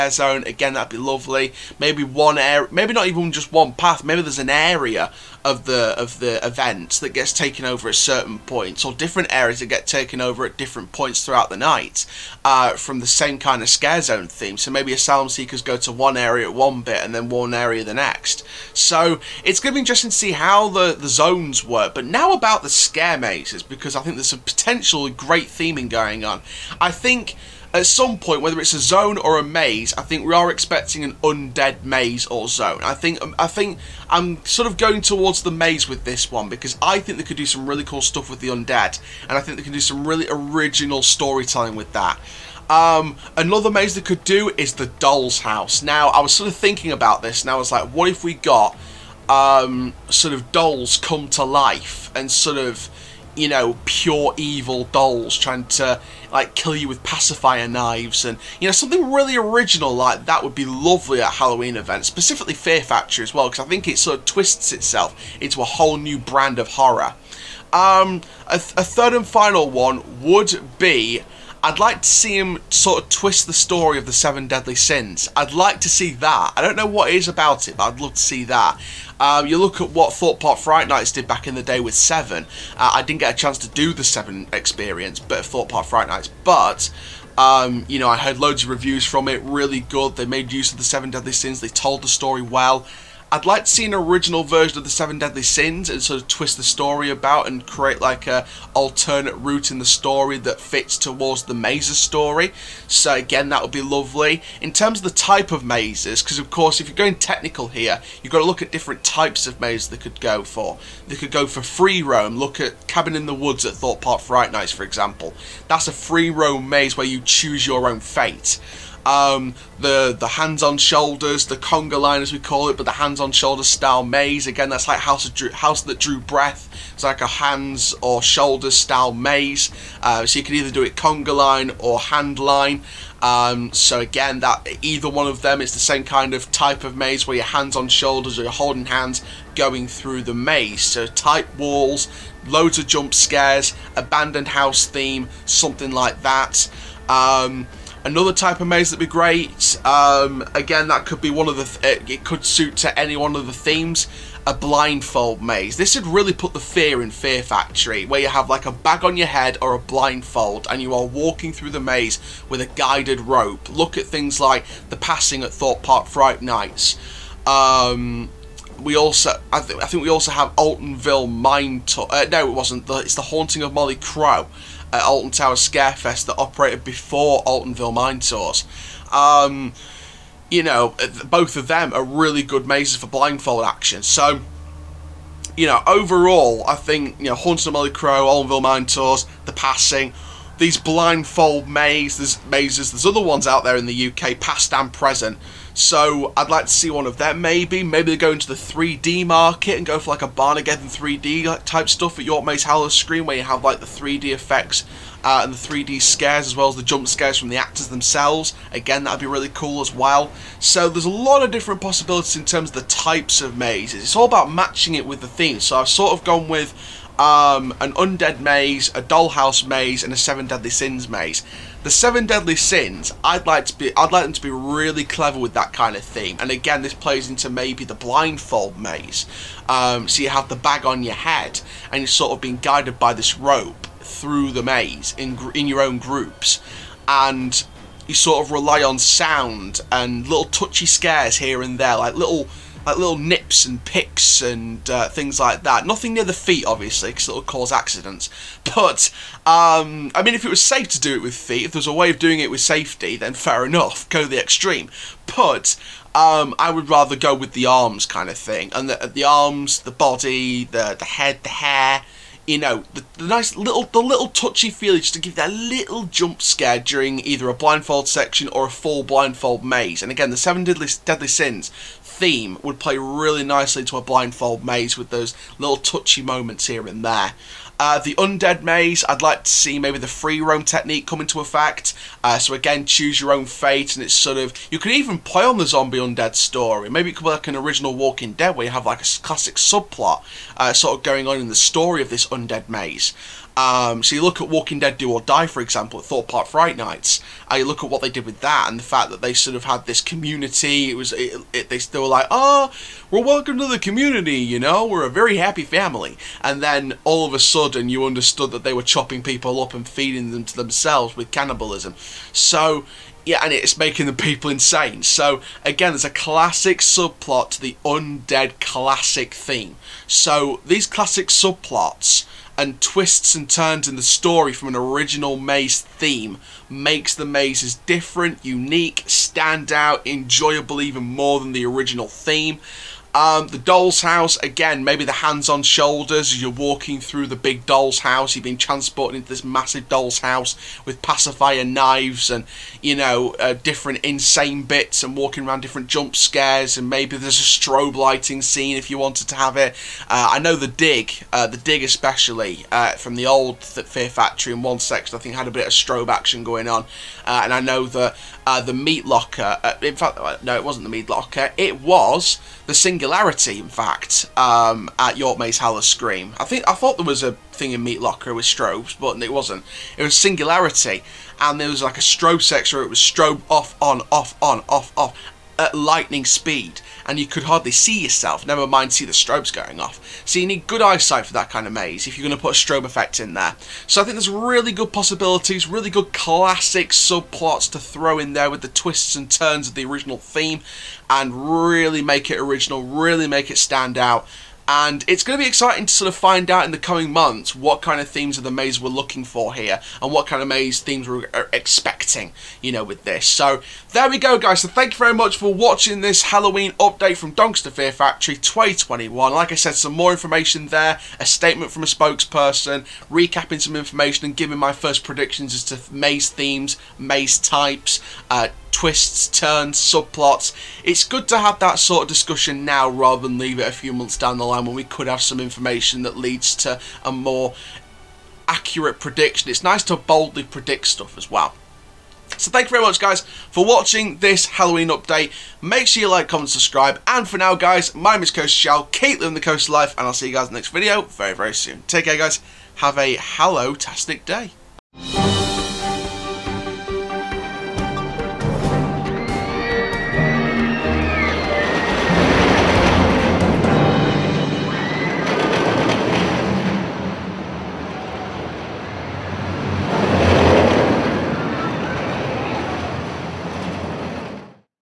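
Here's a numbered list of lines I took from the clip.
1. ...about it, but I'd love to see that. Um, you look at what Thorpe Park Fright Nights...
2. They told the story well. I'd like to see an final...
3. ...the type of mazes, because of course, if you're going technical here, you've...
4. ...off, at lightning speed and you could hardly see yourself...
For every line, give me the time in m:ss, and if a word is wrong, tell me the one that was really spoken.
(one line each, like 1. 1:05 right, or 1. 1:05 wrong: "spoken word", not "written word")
1. 1:17 right
2. 1:31 wrong: "original", not "final"
3. 1:45 right
4. 6:14 right.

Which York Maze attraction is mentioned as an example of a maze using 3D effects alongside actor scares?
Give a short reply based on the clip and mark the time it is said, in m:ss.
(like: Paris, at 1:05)
Barnageddon 3D, at 3:20.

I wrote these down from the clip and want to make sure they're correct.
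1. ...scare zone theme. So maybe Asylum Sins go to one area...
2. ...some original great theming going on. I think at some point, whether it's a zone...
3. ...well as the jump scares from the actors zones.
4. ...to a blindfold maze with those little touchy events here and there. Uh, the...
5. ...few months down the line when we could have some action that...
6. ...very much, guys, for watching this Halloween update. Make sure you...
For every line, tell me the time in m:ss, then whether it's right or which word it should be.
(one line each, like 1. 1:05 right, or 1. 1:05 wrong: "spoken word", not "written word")
1. 0:13 wrong: "Seekers", not "Sins"
2. 0:24 wrong: "potential", not "original"
3. 3:26 wrong: "themselves", not "zones"
4. 4:33 wrong: "moments", not "events"
5. 7:03 wrong: "information", not "action"
6. 7:12 right.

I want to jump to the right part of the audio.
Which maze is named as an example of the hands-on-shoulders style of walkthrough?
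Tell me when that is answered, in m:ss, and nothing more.
2:05.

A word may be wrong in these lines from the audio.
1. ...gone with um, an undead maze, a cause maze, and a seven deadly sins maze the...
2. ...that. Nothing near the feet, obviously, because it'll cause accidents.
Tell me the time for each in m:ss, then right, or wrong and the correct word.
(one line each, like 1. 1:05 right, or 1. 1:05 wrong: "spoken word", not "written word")
1. 3:36 wrong: "dollhouse", not "cause"
2. 4:05 right.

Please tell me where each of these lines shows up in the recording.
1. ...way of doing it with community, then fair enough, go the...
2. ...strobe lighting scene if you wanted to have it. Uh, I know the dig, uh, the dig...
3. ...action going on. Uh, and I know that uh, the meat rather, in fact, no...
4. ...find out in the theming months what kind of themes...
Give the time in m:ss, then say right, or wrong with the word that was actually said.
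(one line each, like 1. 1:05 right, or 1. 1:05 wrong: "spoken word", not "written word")
1. 4:11 wrong: "safety", not "community"
2. 5:47 right
3. 5:56 wrong: "locker", not "rather"
4. 6:36 wrong: "coming", not "theming".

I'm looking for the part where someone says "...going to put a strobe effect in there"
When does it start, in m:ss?
6:22.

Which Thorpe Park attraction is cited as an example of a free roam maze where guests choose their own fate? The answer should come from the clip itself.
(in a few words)
Cabin in the Woods.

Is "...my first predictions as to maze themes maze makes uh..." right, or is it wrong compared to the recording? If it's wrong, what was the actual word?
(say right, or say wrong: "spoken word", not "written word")
wrong: "types", not "makes".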